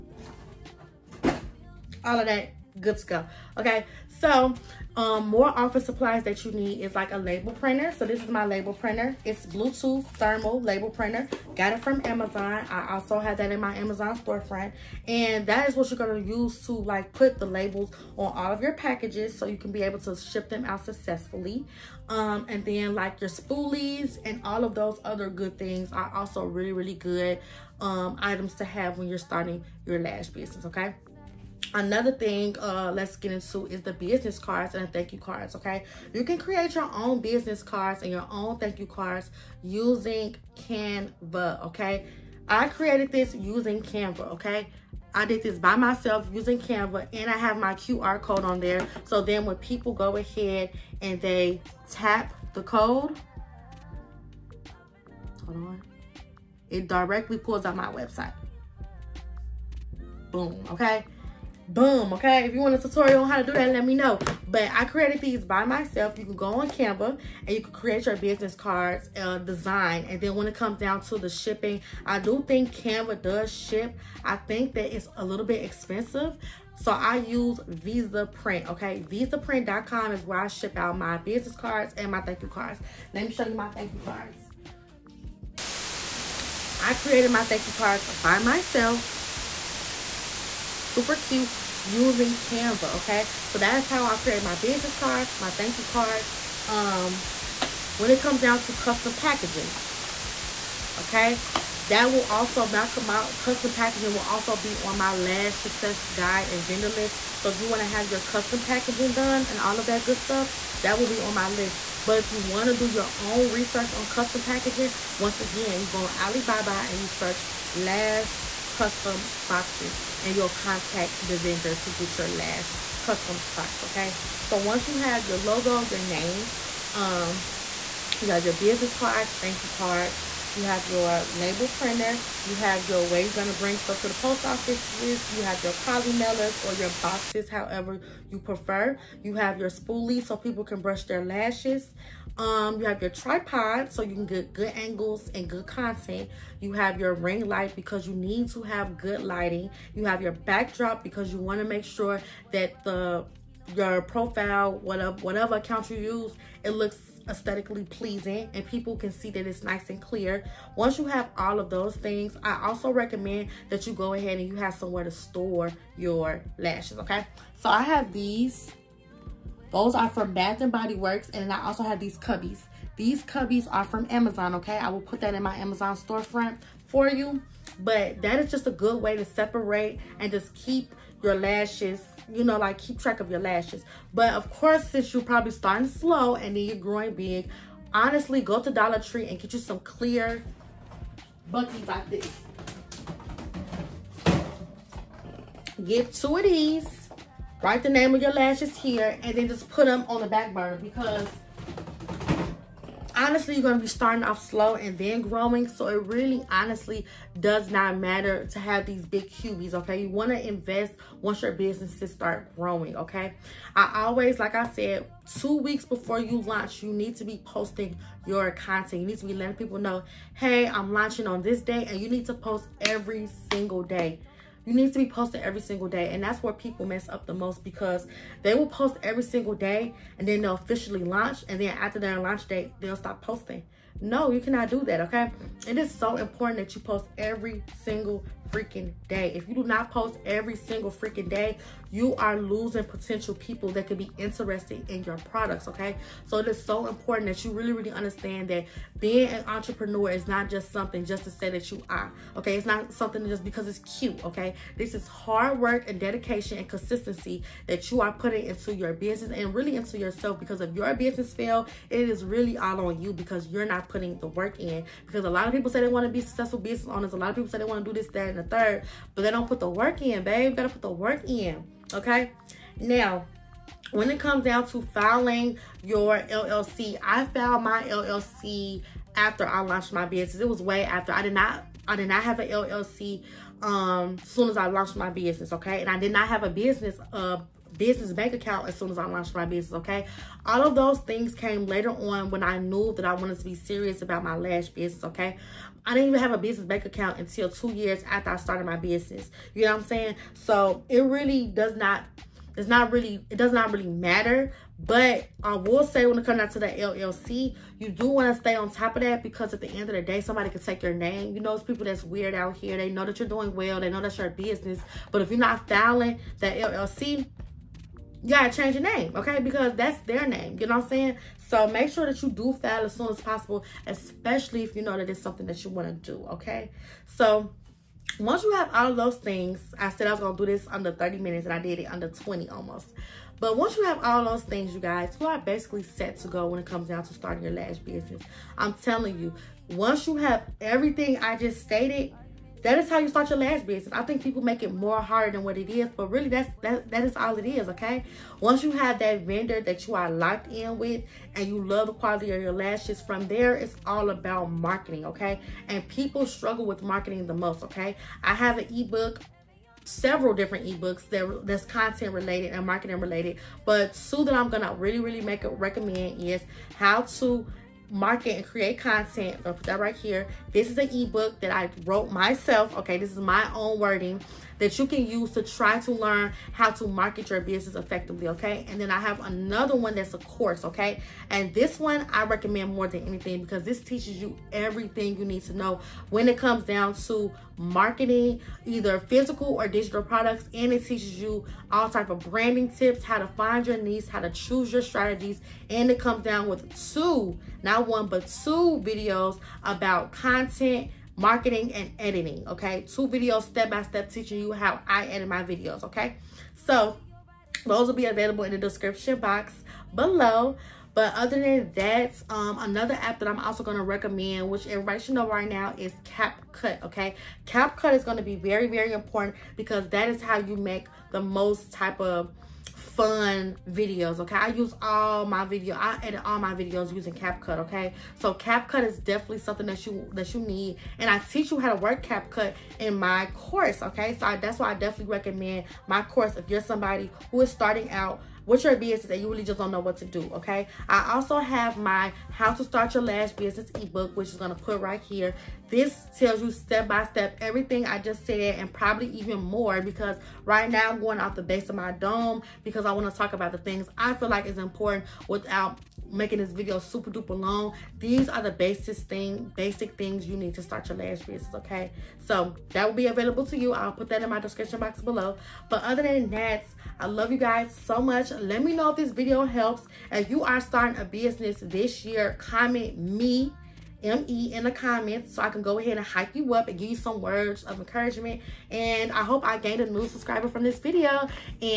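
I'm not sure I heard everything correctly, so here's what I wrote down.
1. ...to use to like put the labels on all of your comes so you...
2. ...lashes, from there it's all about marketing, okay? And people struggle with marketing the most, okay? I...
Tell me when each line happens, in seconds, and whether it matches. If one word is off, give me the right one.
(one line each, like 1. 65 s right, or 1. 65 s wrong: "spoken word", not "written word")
1. 16 s wrong: "packages", not "comes"
2. 352 s right.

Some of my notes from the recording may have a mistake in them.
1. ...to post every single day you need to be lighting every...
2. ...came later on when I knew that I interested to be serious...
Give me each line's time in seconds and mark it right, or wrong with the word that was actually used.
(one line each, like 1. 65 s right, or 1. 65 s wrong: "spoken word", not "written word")
1. 222 s wrong: "posting", not "lighting"
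2. 291 s wrong: "wanted", not "interested".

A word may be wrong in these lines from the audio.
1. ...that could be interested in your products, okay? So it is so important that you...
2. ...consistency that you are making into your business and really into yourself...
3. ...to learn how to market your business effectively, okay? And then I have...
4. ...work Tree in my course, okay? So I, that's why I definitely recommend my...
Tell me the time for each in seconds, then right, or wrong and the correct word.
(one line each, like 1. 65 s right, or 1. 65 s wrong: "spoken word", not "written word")
1. 243 s right
2. 256 s wrong: "putting", not "making"
3. 375 s right
4. 431 s wrong: "CapCut", not "Tree".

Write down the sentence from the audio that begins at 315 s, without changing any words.
But if you're not filing that LLC, you gotta change your name, okay?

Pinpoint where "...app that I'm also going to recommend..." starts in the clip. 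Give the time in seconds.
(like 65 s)
412 s.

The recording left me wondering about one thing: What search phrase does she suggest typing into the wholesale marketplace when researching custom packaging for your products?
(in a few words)
lash custom boxes.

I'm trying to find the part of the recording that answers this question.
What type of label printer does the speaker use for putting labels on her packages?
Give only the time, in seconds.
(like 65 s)
9 s.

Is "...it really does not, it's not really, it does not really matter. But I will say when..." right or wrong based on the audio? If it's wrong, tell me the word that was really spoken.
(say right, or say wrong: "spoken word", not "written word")
right.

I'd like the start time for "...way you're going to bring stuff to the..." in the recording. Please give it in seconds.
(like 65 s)
133 s.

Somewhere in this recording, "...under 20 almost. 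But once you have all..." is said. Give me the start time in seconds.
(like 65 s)
331 s.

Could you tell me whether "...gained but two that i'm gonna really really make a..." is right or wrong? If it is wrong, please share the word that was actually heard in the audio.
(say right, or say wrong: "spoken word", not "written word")
wrong: "related", not "gained".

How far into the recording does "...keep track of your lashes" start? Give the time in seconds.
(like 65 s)
182 s.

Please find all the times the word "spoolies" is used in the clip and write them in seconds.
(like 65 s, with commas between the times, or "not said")
23 s, 139 s.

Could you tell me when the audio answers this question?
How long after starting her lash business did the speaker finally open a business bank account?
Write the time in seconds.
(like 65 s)
297 s.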